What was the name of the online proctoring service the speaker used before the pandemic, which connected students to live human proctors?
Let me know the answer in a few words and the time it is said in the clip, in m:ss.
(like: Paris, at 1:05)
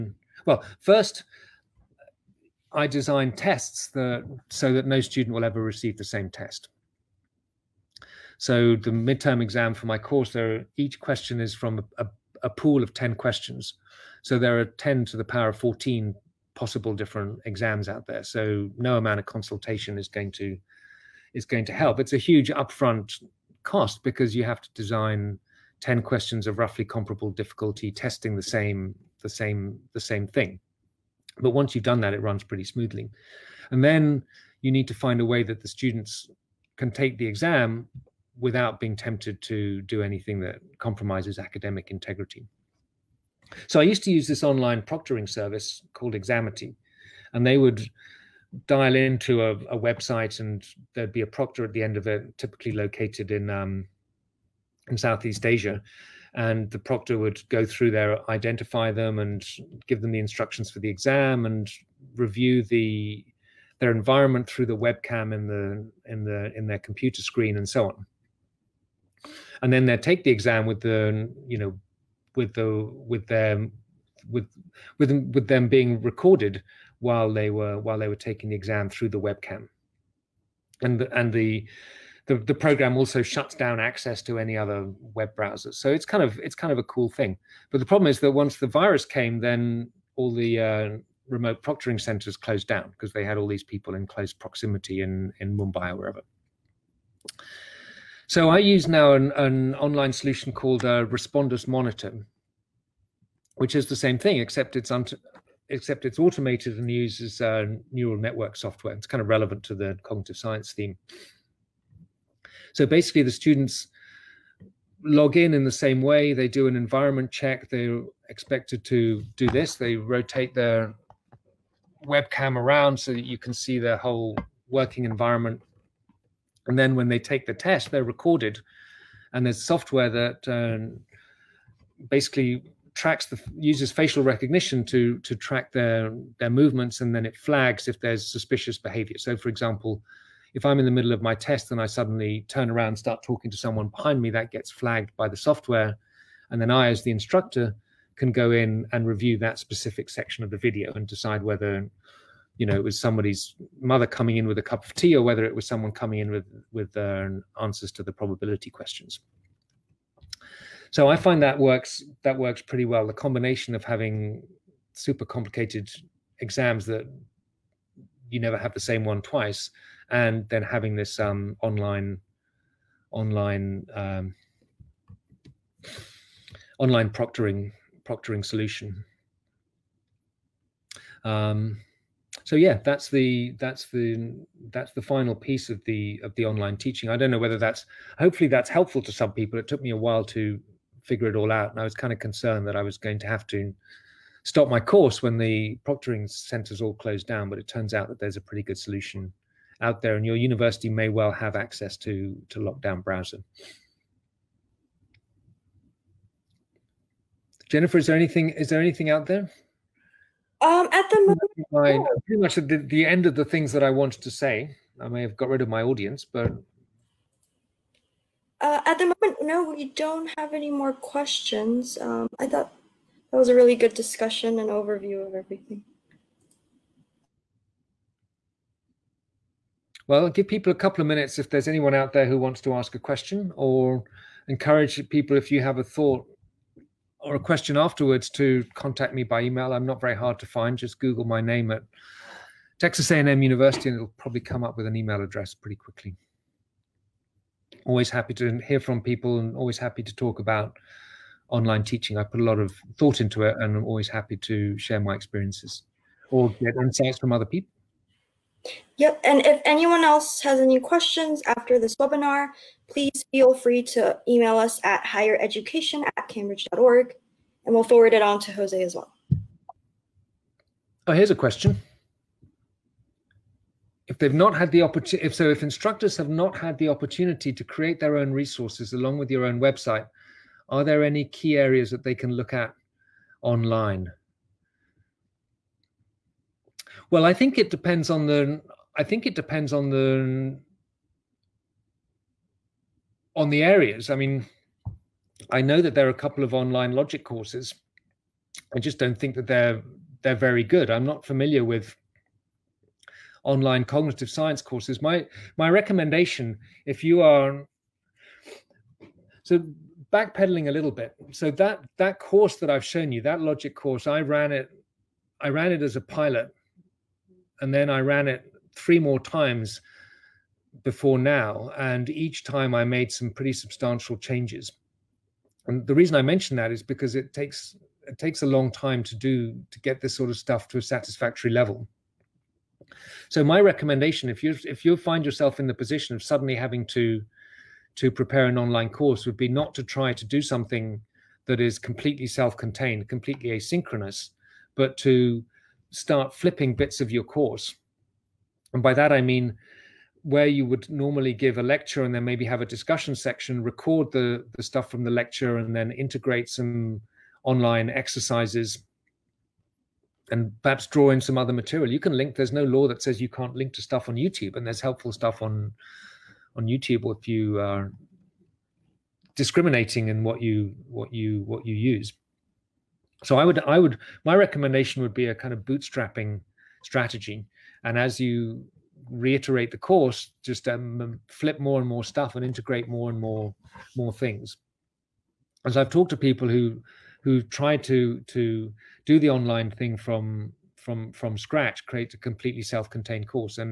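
Examity, at 0:46.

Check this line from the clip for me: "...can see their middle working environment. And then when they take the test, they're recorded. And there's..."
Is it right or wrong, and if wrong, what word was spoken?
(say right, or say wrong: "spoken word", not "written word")
wrong: "whole", not "middle".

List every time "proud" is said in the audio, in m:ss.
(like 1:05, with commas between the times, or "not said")
not said.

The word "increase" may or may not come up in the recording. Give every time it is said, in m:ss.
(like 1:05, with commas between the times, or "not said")
not said.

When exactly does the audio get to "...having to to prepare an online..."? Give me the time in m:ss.
5:36.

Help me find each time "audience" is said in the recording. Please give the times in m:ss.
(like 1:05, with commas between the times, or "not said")
3:35.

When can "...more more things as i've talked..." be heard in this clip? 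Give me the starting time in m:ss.
6:23.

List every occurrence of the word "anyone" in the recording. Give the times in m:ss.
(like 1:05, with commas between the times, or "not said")
3:51, 4:19.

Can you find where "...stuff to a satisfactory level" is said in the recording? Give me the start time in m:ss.
5:30.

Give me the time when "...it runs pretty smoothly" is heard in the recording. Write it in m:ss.
0:32.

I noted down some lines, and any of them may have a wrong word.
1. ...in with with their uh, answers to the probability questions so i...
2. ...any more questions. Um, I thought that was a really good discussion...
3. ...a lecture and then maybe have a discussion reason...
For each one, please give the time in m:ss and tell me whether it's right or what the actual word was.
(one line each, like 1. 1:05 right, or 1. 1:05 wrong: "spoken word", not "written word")
1. 2:36 right
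2. 3:40 right
3. 5:51 wrong: "section", not "reason".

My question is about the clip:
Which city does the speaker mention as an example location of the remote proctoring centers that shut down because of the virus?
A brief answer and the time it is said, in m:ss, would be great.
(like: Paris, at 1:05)
Mumbai, at 1:35.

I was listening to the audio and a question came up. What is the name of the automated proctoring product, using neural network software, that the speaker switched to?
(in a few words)
Respondus Monitor.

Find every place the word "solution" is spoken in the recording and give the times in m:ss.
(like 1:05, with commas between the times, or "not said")
1:40, 2:58, 3:18.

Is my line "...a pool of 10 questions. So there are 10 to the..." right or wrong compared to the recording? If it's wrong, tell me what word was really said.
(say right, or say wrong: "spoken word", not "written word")
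right.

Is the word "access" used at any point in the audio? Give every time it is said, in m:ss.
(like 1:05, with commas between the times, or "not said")
1:23, 3:21.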